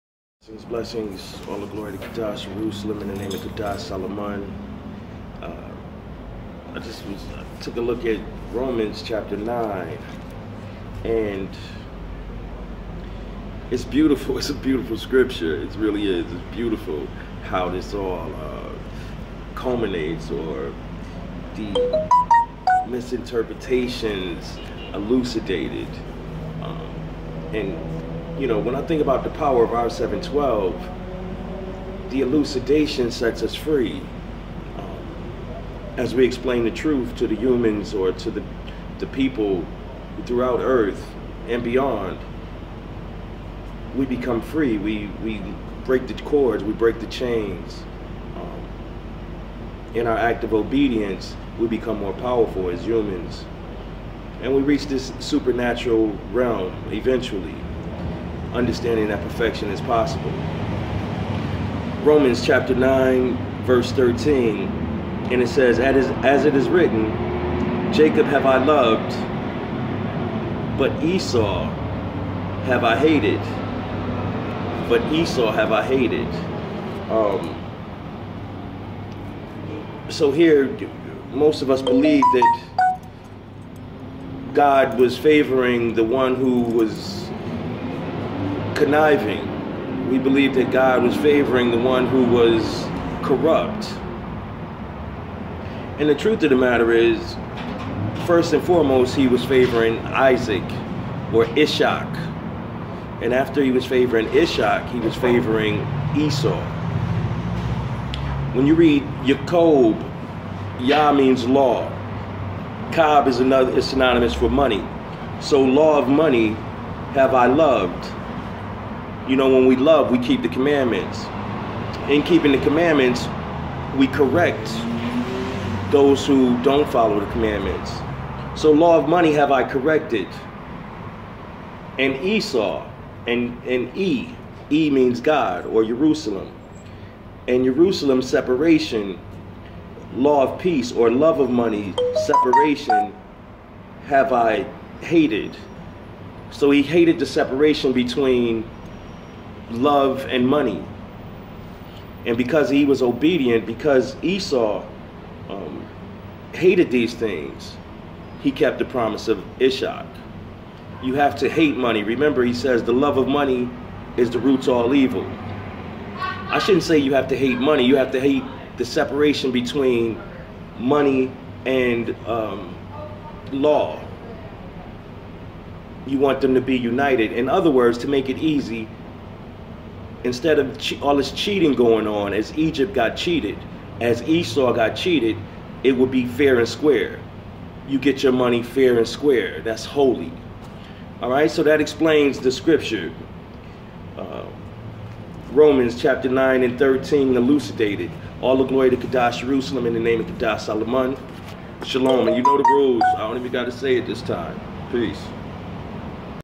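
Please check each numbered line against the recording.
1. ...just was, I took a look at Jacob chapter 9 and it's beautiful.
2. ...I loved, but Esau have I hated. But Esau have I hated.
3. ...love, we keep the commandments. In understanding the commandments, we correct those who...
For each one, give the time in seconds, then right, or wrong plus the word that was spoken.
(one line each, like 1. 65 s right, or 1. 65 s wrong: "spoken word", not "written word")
1. 6 s wrong: "Romans", not "Jacob"
2. 68 s right
3. 119 s wrong: "keeping", not "understanding".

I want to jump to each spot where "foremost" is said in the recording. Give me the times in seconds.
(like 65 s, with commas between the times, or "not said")
98 s.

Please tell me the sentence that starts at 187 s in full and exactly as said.
You get your money fair and square.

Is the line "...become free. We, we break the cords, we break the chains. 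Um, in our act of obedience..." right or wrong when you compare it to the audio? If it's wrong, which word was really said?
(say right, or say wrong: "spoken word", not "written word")
right.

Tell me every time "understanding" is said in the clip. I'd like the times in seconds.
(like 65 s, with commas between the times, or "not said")
58 s.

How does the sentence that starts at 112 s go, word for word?
Cob is another is synonymous for money.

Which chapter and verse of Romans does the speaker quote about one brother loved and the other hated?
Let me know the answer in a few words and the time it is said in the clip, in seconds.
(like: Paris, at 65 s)
Chapter 9, verse 13, at 62 s.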